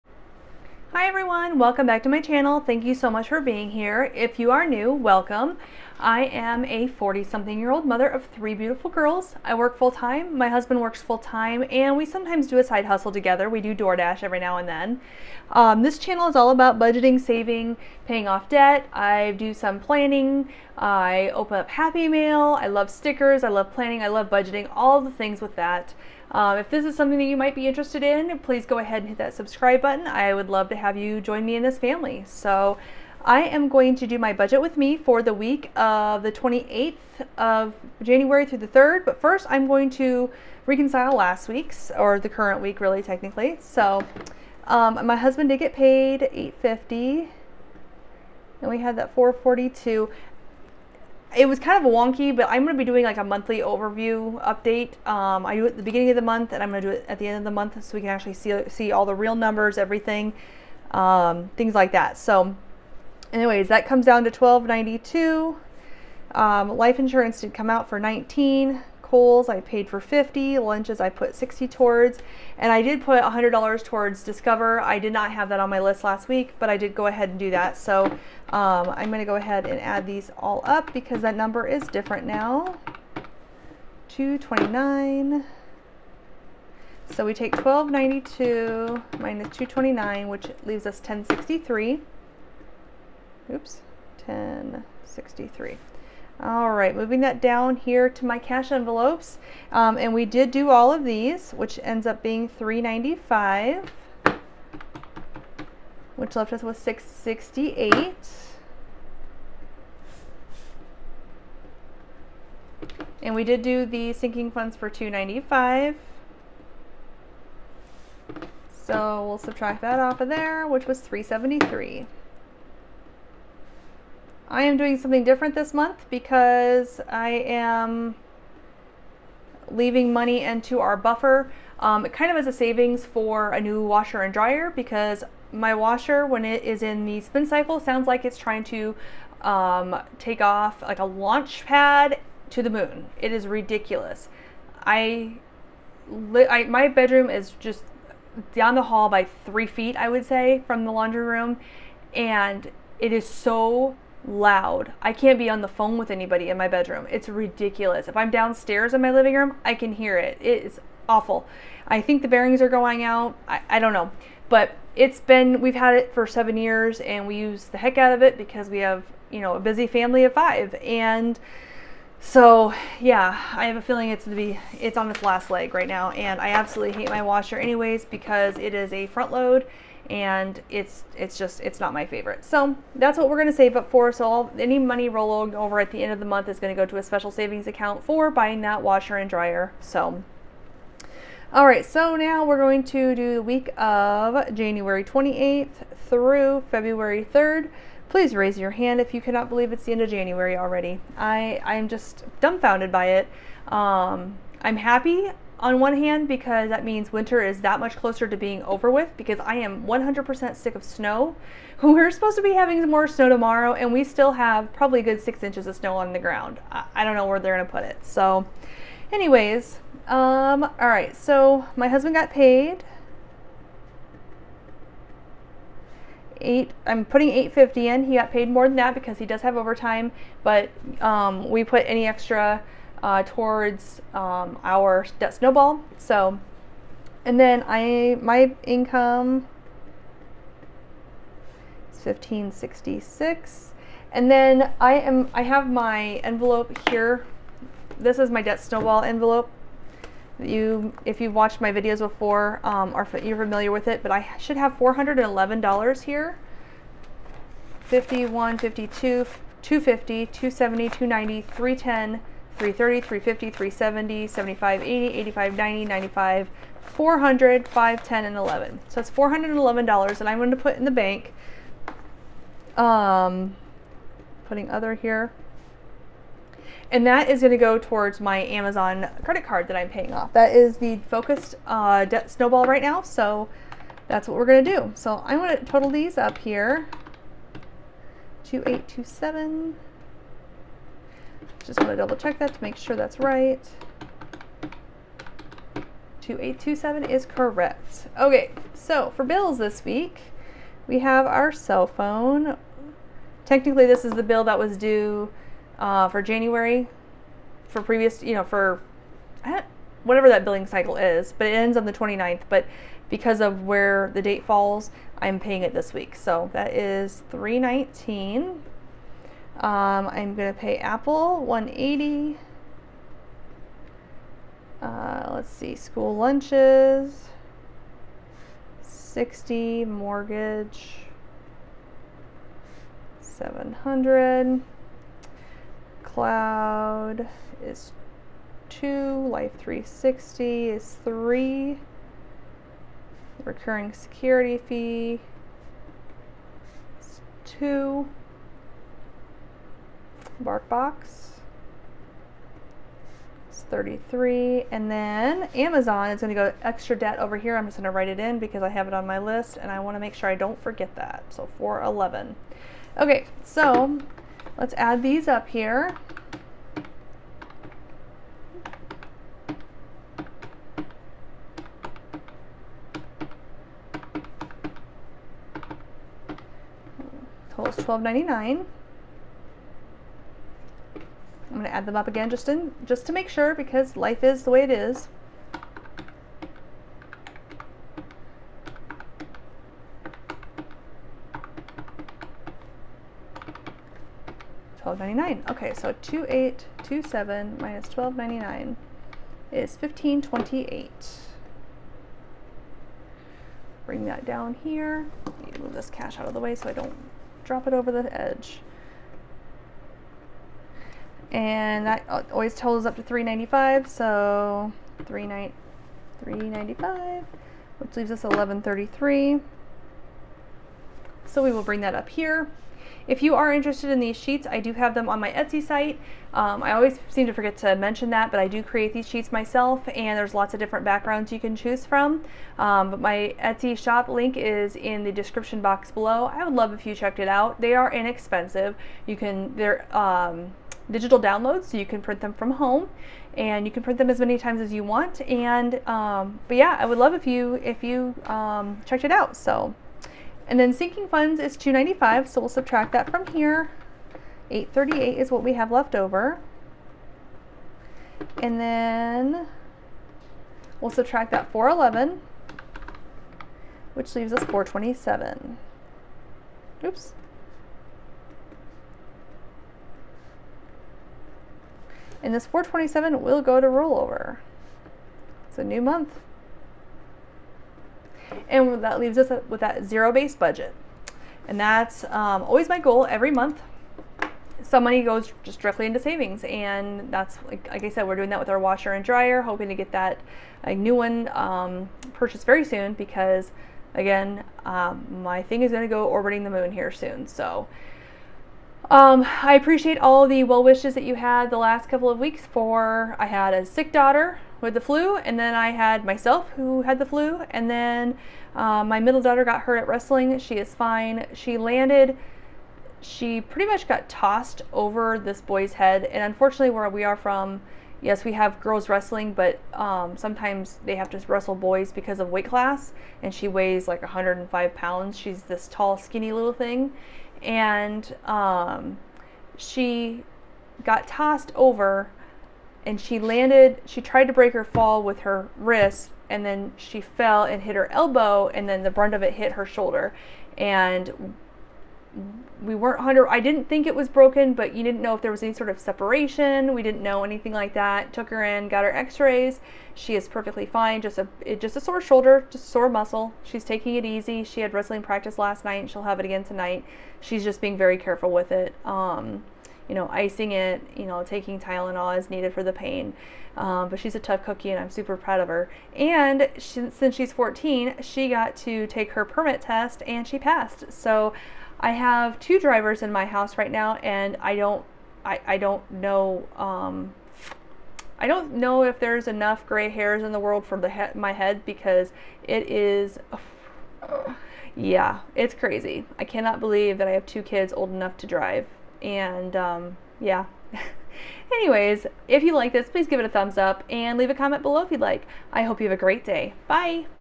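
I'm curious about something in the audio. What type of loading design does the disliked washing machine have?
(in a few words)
Front load.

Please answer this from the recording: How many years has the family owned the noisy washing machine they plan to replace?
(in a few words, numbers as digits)
7 years.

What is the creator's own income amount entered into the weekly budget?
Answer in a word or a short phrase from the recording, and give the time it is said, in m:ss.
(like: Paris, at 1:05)
1566, at 4:02.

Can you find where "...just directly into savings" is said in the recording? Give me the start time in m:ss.
8:05.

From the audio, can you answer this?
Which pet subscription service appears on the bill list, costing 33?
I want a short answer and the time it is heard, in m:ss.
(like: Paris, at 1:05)
Bark Box, at 5:50.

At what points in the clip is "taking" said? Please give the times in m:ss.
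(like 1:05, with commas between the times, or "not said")
9:13, 9:21.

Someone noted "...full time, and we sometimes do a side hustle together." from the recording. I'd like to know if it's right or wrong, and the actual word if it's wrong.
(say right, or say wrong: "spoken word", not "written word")
right.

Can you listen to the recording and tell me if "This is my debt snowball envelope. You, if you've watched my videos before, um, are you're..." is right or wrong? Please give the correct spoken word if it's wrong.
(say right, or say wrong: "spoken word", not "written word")
right.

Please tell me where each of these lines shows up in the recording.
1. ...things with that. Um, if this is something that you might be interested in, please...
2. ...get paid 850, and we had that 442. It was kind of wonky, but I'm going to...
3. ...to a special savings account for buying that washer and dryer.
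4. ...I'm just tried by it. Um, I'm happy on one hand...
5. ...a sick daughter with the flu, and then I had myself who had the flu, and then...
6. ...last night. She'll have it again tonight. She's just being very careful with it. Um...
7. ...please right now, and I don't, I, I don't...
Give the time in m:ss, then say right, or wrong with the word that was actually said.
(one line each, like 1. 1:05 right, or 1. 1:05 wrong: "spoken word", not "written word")
1. 0:25 right
2. 0:45 right
3. 3:06 right
4. 3:21 wrong: "dumbfounded", not "tried"
5. 8:23 right
6. 9:15 right
7. 9:33 wrong: "house", not "please".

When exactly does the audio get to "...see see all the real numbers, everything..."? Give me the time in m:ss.
0:58.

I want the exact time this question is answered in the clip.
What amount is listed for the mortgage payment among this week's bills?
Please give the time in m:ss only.
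5:29.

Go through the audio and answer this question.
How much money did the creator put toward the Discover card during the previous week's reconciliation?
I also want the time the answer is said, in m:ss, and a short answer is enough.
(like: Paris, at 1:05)
$100, at 1:13.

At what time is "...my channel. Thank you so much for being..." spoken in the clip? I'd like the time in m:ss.
0:02.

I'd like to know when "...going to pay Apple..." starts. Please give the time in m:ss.
5:20.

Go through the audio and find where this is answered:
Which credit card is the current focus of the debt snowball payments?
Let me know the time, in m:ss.
4:38.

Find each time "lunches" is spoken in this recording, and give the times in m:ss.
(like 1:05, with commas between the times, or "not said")
1:10, 5:26.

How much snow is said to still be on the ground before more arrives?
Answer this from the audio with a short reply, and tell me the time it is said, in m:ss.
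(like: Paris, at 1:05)
6 inches, at 3:35.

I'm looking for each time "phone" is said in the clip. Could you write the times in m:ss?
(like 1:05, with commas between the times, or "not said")
2:35, 5:01.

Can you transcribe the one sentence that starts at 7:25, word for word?
And um, but yeah, I would love if you if you um, checked it out.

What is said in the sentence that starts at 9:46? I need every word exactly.
I cannot believe that I have two kids old enough to drive, and um, yeah.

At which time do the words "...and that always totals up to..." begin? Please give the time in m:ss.
6:51.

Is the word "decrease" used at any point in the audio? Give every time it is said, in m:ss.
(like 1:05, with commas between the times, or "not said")
not said.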